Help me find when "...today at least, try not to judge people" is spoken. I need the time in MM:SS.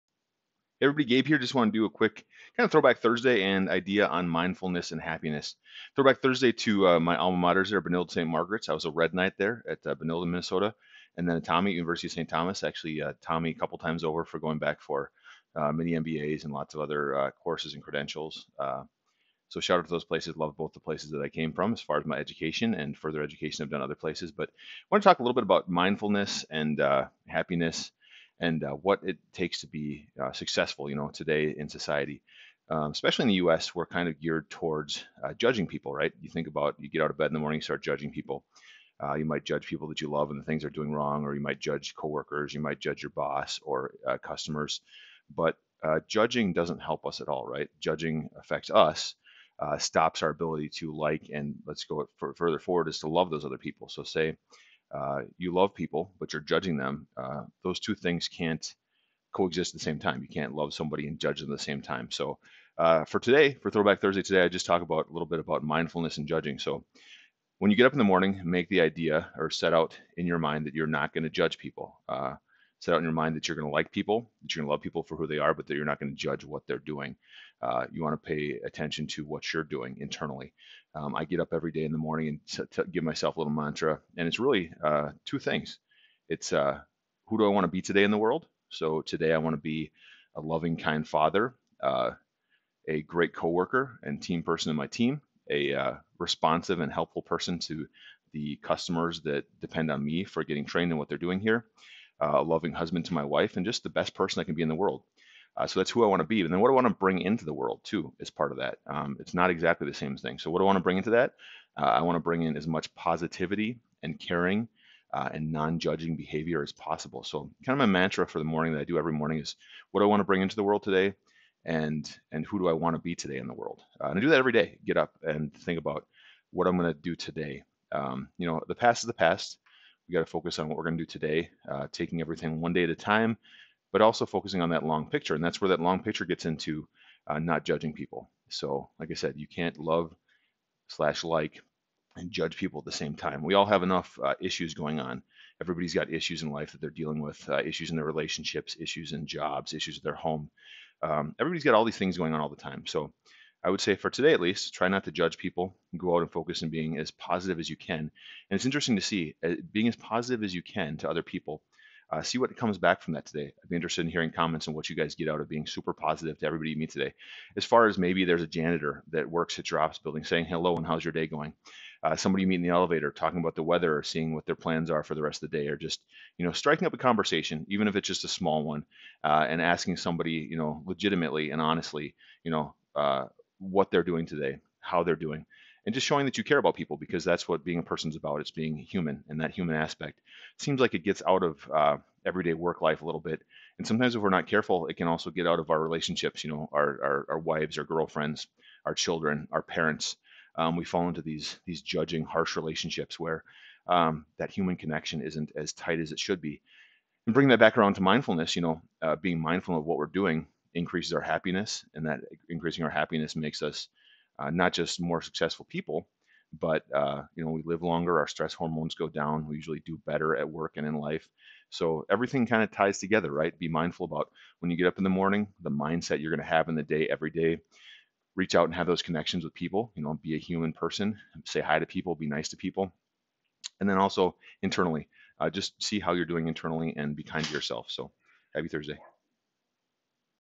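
02:34.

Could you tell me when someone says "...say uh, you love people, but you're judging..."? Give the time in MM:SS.
00:54.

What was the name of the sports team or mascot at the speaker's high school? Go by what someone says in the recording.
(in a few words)
Red Knight.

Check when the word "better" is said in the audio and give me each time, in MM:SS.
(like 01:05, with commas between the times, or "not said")
03:40.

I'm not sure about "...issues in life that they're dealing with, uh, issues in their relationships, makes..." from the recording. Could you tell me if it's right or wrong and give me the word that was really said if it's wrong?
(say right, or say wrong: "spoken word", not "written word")
wrong: "issues", not "makes".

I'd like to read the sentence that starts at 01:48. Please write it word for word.
Um, it's not exactly the same thing.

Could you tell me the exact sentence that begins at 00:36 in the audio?
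You think about you get out of bed in the morning, you start judging people.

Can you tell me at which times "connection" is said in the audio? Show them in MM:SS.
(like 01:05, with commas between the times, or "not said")
03:24, 03:49.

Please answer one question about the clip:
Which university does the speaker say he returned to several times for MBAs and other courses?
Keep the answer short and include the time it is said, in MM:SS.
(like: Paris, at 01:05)
University of St. Thomas, at 00:11.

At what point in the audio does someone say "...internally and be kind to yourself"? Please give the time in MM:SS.
03:56.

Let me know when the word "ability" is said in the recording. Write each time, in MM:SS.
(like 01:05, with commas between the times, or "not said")
00:50.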